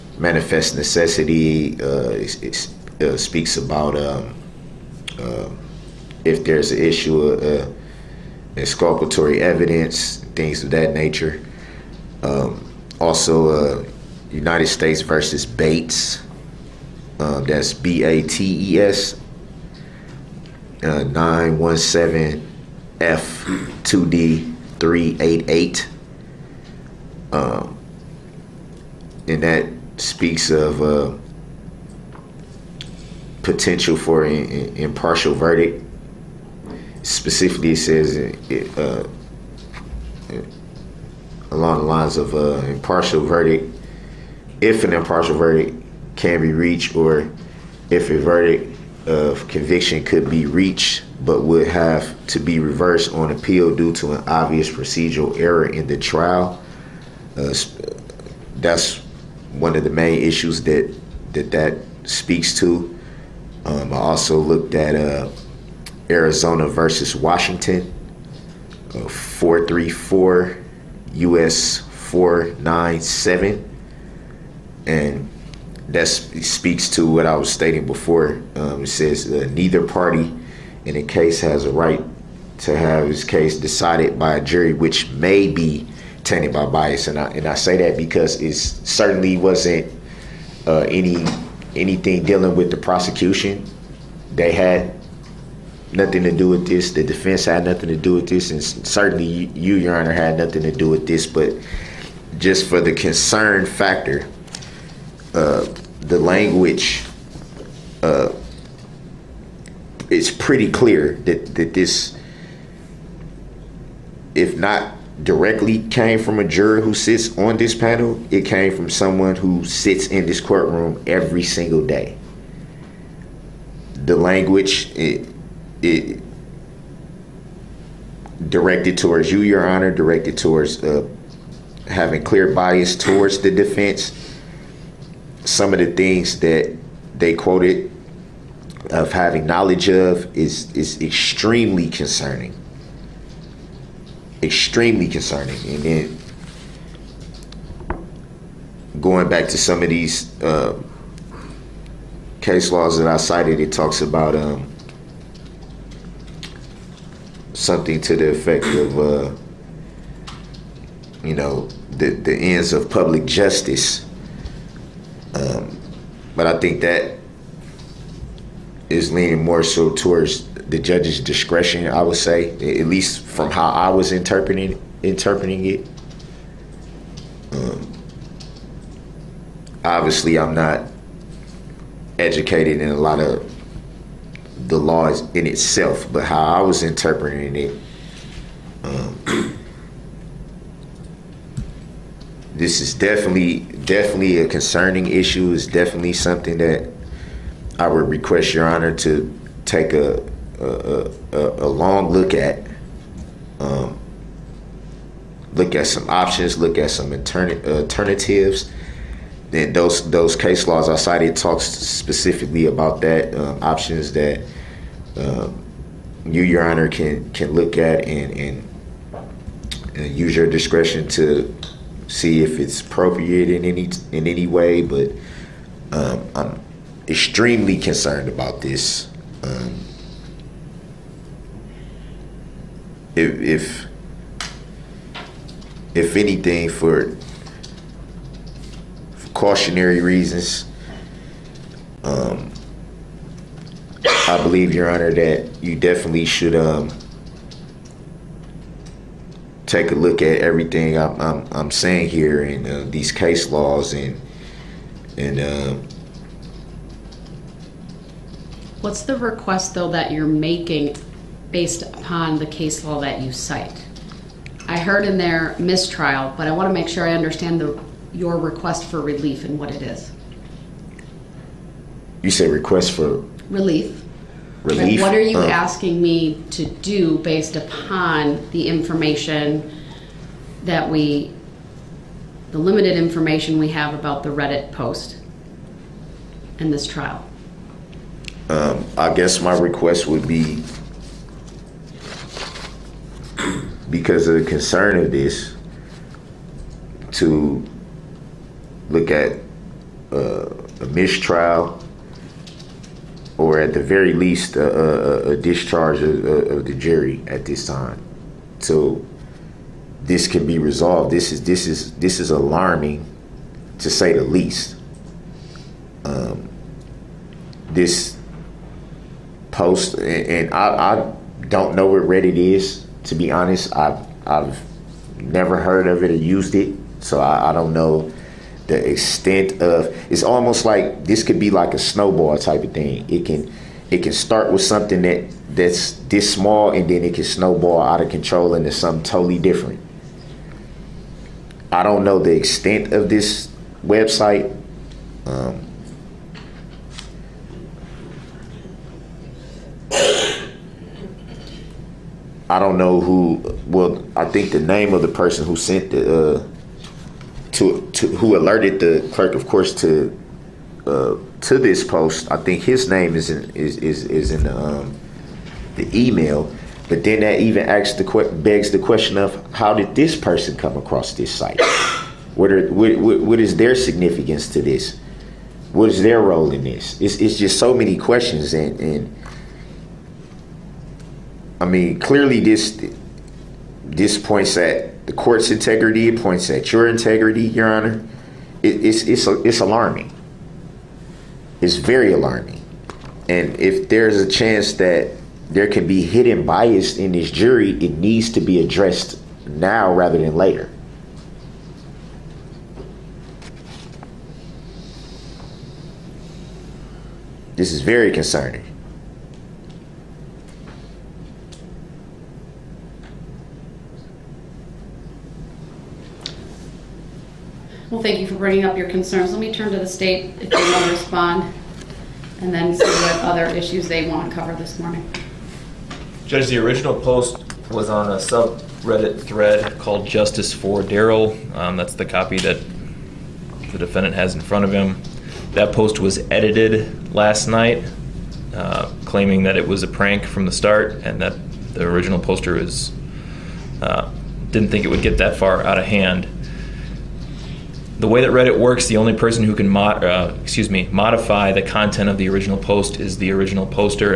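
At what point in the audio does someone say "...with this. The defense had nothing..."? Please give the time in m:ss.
1:36.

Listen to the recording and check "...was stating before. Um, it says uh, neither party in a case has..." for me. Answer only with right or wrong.
right.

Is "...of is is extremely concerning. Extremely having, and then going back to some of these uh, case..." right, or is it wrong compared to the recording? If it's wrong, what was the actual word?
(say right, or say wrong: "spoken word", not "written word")
wrong: "concerning", not "having".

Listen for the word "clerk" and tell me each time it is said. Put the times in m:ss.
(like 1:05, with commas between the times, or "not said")
5:59.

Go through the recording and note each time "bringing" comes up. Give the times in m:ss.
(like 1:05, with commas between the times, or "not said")
6:58.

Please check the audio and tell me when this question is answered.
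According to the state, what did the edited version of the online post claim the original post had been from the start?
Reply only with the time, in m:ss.
7:19.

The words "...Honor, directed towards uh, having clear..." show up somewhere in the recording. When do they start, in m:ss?
2:09.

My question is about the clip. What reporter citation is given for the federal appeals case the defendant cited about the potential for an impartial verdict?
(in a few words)
917 F.2d 388.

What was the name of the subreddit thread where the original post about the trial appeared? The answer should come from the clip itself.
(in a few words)
Justice for Darrell.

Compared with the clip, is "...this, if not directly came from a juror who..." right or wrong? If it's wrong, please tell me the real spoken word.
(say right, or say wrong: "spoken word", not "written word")
right.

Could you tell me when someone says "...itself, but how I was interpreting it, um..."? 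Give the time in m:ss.
3:05.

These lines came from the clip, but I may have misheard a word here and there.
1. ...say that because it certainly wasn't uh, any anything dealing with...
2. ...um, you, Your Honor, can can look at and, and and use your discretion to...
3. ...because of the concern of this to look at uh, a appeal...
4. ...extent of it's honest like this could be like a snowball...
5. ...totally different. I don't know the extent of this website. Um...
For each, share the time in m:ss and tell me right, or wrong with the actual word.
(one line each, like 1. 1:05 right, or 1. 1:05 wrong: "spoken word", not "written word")
1. 1:27 right
2. 3:35 right
3. 4:53 wrong: "mistrial", not "appeal"
4. 5:28 wrong: "almost", not "honest"
5. 5:39 right.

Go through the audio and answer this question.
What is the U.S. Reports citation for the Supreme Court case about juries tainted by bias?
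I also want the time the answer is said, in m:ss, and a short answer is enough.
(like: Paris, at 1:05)
434 U.S. 497, at 1:09.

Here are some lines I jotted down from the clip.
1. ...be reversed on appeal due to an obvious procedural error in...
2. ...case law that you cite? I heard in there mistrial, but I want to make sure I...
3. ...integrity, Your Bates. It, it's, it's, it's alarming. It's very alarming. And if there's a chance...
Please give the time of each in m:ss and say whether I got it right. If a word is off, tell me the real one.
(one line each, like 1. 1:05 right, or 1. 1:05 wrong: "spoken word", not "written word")
1. 0:52 right
2. 4:22 right
3. 6:26 wrong: "Honor", not "Bates".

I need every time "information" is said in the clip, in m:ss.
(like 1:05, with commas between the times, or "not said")
4:38, 4:42.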